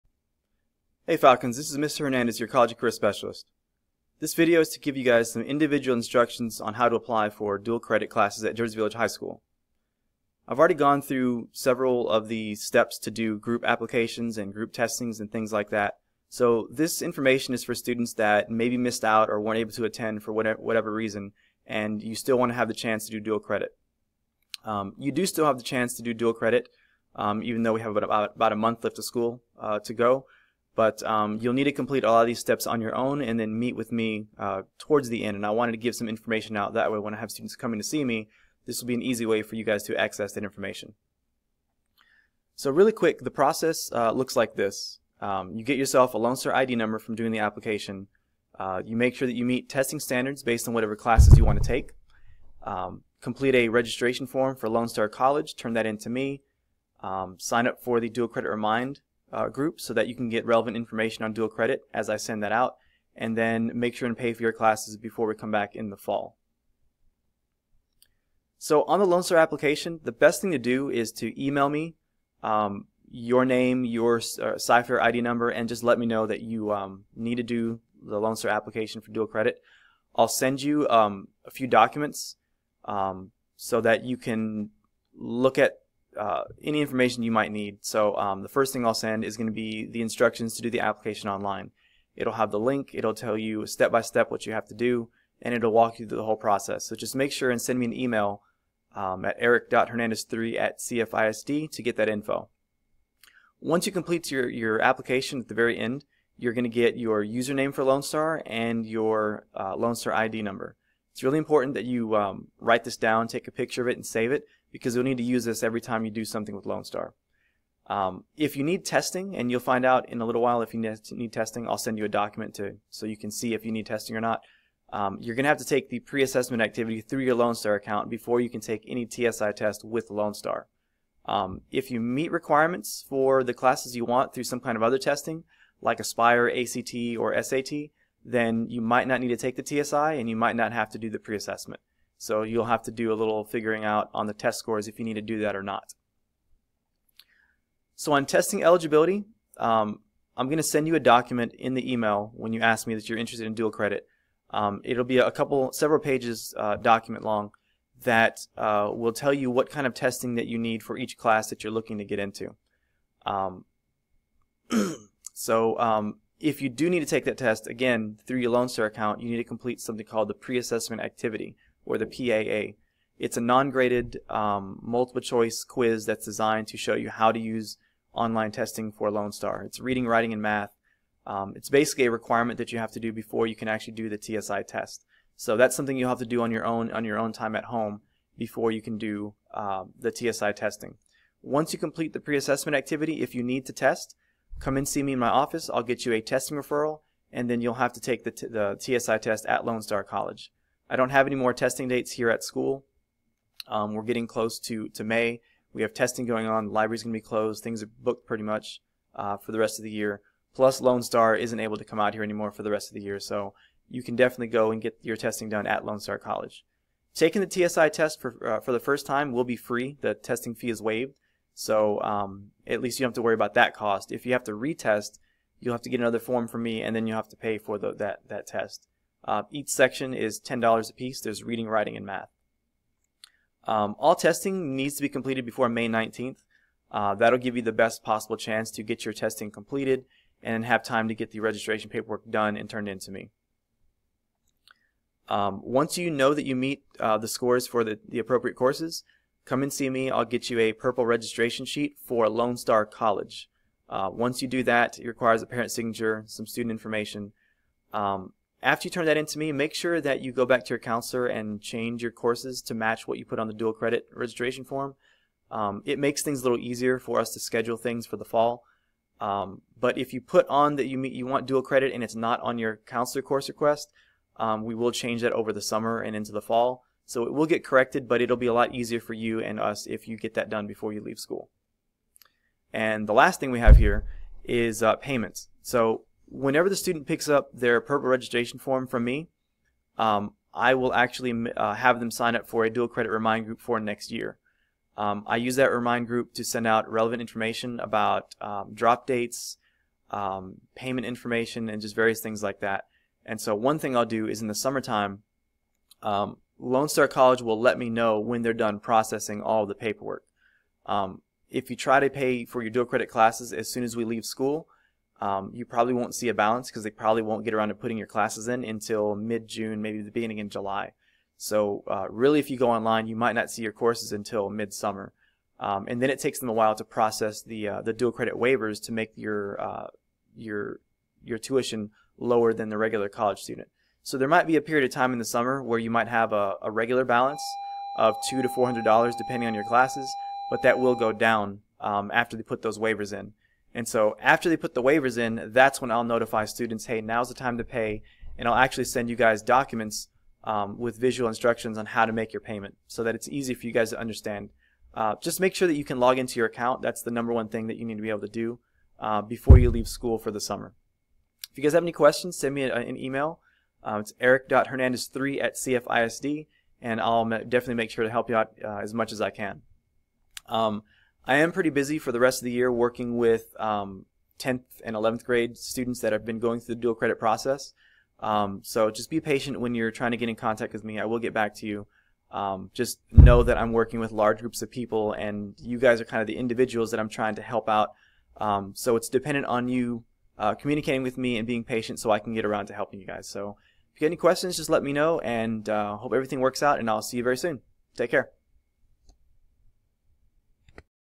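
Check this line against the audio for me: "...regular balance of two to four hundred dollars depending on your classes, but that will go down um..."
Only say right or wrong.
right.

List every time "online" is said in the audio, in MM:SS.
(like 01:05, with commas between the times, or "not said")
01:31, 02:58, 05:22.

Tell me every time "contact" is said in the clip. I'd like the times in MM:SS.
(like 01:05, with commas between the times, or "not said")
06:20.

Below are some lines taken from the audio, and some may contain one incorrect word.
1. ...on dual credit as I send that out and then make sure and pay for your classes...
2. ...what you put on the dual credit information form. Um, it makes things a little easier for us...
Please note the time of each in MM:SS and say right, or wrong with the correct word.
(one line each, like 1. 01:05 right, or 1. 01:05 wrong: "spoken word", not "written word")
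1. 01:01 right
2. 04:23 wrong: "registration", not "information".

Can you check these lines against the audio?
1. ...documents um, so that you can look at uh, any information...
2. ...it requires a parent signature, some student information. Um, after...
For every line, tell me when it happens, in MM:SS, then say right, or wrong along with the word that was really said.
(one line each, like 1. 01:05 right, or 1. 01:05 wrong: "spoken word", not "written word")
1. 01:21 right
2. 04:14 right.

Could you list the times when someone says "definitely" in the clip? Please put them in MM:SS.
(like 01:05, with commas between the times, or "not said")
03:34, 06:07.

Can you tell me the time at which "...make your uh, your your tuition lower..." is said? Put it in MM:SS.
05:28.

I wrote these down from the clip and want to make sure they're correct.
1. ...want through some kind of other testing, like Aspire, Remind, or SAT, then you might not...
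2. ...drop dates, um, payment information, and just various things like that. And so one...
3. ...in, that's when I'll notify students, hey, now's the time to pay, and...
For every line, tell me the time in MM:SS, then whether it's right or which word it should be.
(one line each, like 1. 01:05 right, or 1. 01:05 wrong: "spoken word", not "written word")
1. 02:14 wrong: "ACT", not "Remind"
2. 04:58 right
3. 05:45 right.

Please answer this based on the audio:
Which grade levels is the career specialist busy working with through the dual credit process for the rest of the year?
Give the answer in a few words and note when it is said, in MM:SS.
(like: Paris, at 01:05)
10th and 11th, at 06:14.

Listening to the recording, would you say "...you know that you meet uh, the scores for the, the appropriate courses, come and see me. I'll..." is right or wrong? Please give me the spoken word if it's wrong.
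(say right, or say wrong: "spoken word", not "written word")
right.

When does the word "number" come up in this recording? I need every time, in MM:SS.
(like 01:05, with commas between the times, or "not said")
00:46, 01:15, 01:50, 05:57.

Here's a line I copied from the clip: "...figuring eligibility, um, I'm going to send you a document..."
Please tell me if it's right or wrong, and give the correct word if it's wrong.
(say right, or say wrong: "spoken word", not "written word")
wrong: "testing", not "figuring".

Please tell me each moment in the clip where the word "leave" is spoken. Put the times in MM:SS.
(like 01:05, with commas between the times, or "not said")
04:41, 05:14, 05:59.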